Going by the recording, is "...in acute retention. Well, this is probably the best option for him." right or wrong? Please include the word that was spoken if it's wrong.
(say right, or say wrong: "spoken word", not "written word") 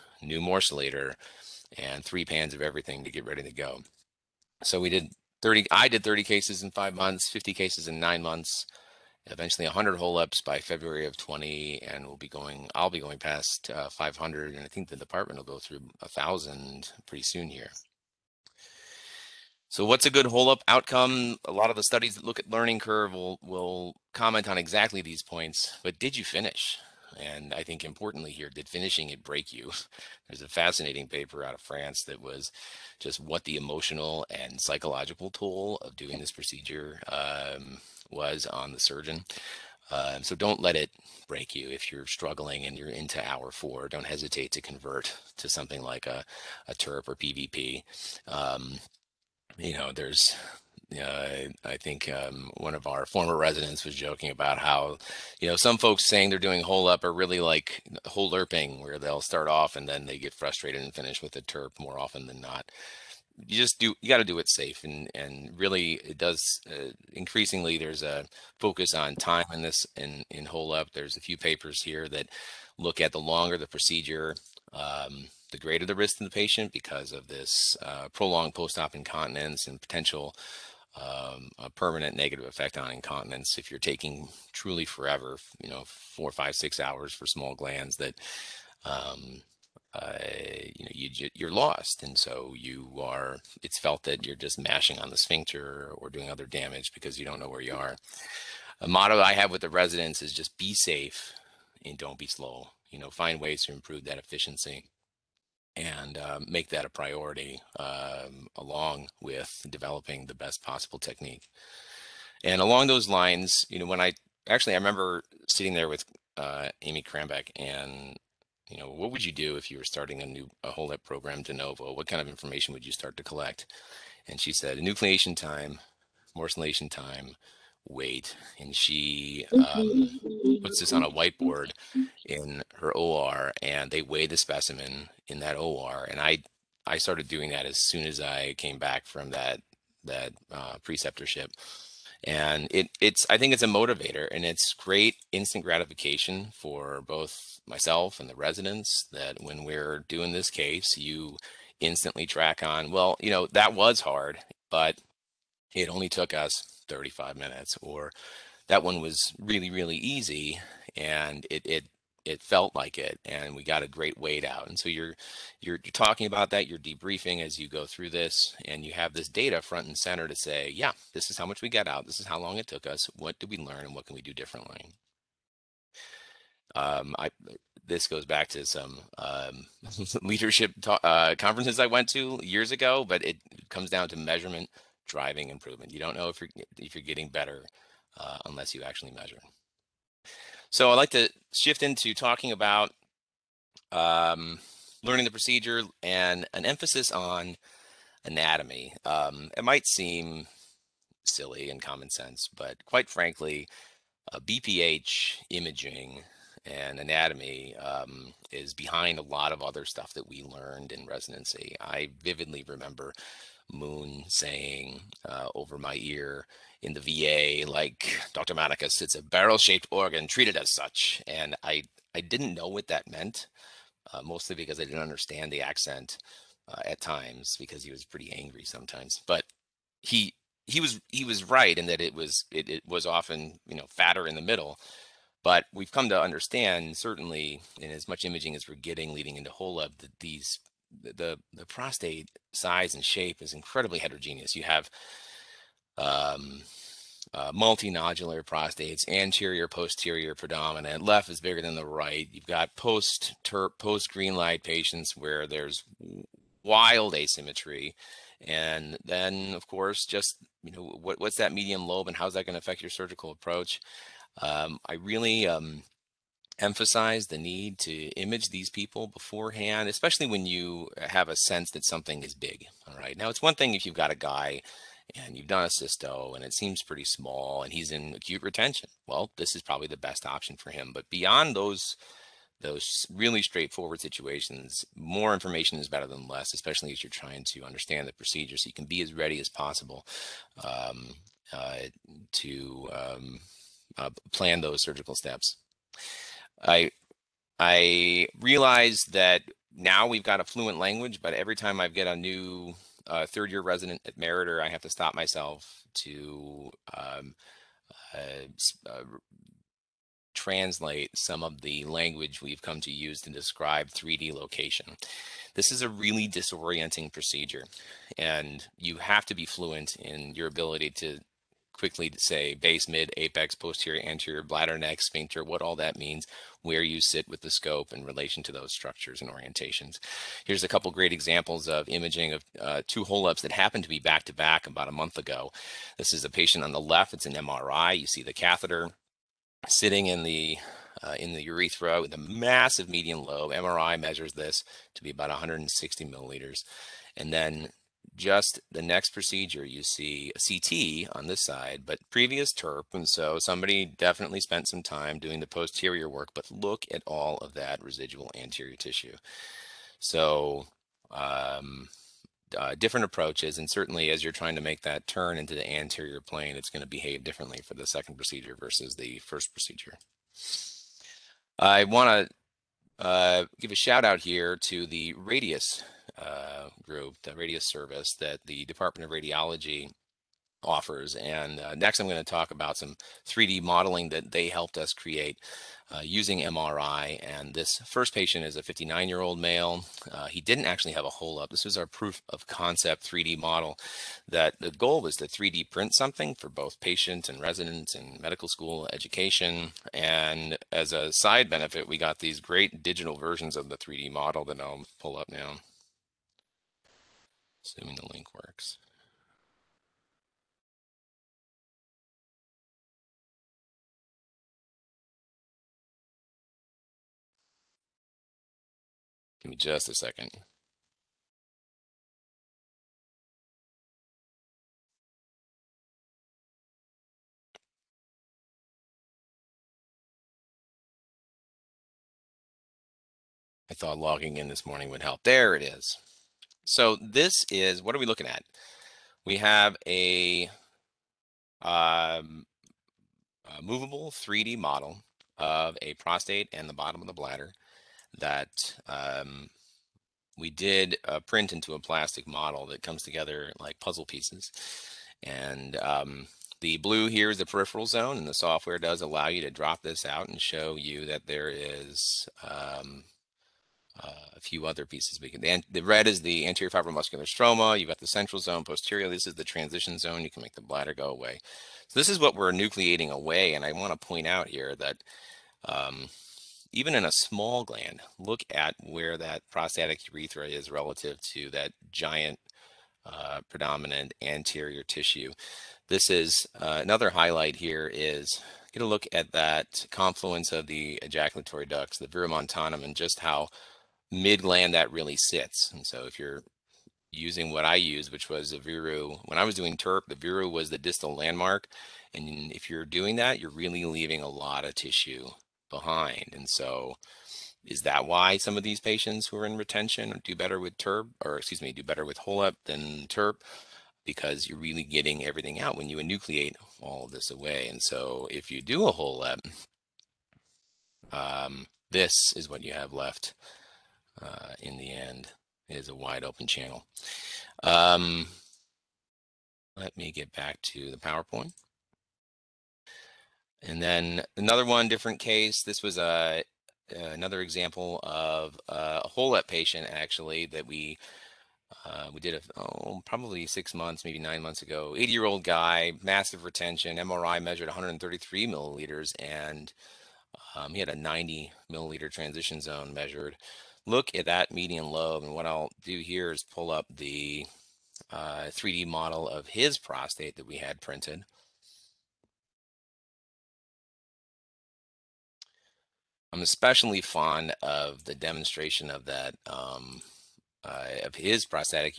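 right.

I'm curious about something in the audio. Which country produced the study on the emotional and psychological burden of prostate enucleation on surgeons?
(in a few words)
France.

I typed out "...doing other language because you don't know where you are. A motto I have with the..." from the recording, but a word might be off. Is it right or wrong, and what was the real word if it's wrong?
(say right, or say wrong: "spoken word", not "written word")
wrong: "damage", not "language".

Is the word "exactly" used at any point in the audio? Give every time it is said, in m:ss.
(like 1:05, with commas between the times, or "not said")
0:24.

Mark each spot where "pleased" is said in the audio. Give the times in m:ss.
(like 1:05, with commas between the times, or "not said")
not said.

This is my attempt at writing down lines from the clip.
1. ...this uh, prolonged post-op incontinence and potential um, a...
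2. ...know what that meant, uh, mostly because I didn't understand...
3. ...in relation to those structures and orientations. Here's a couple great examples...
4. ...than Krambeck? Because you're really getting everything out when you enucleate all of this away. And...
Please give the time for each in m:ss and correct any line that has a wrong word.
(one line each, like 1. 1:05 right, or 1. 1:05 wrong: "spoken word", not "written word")
1. 1:17 right
2. 3:42 right
3. 5:27 right
4. 8:32 wrong: "TURP", not "Krambeck".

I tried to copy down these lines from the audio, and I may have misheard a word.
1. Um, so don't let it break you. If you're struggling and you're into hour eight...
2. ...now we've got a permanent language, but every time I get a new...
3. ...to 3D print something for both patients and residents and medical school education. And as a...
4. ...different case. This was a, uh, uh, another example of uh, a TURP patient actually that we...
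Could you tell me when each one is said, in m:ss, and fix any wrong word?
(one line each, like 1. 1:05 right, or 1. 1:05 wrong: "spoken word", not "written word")
1. 0:39 wrong: "four", not "eight"
2. 4:59 wrong: "fluent", not "permanent"
3. 6:35 right
4. 8:54 wrong: "HOLEP", not "TURP".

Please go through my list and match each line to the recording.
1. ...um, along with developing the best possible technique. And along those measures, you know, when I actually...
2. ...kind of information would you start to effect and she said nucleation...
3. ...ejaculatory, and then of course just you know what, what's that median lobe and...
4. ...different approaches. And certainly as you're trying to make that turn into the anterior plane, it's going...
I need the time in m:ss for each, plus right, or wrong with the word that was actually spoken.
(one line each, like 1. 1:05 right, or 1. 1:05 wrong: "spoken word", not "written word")
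1. 1:47 wrong: "lines", not "measures"
2. 2:02 wrong: "collect", not "effect"
3. 4:17 wrong: "asymmetry", not "ejaculatory"
4. 6:02 right.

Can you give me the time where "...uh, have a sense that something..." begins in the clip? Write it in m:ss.
4:31.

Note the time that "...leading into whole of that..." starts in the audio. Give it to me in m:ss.
3:59.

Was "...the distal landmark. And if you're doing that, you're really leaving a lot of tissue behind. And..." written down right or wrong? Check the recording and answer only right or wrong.
right.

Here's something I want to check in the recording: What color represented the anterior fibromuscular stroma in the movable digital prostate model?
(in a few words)
red.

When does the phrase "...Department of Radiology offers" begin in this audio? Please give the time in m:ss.
6:18.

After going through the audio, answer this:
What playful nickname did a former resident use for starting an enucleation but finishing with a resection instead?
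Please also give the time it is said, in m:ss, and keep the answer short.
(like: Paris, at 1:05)
hole lerping, at 0:58.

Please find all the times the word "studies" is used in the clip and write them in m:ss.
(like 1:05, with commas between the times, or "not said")
0:21.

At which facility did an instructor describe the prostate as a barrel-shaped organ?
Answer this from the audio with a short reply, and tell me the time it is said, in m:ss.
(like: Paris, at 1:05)
the VA, at 3:36.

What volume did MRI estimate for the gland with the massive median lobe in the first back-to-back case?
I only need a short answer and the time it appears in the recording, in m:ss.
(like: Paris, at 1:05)
160 milliliters, at 5:45.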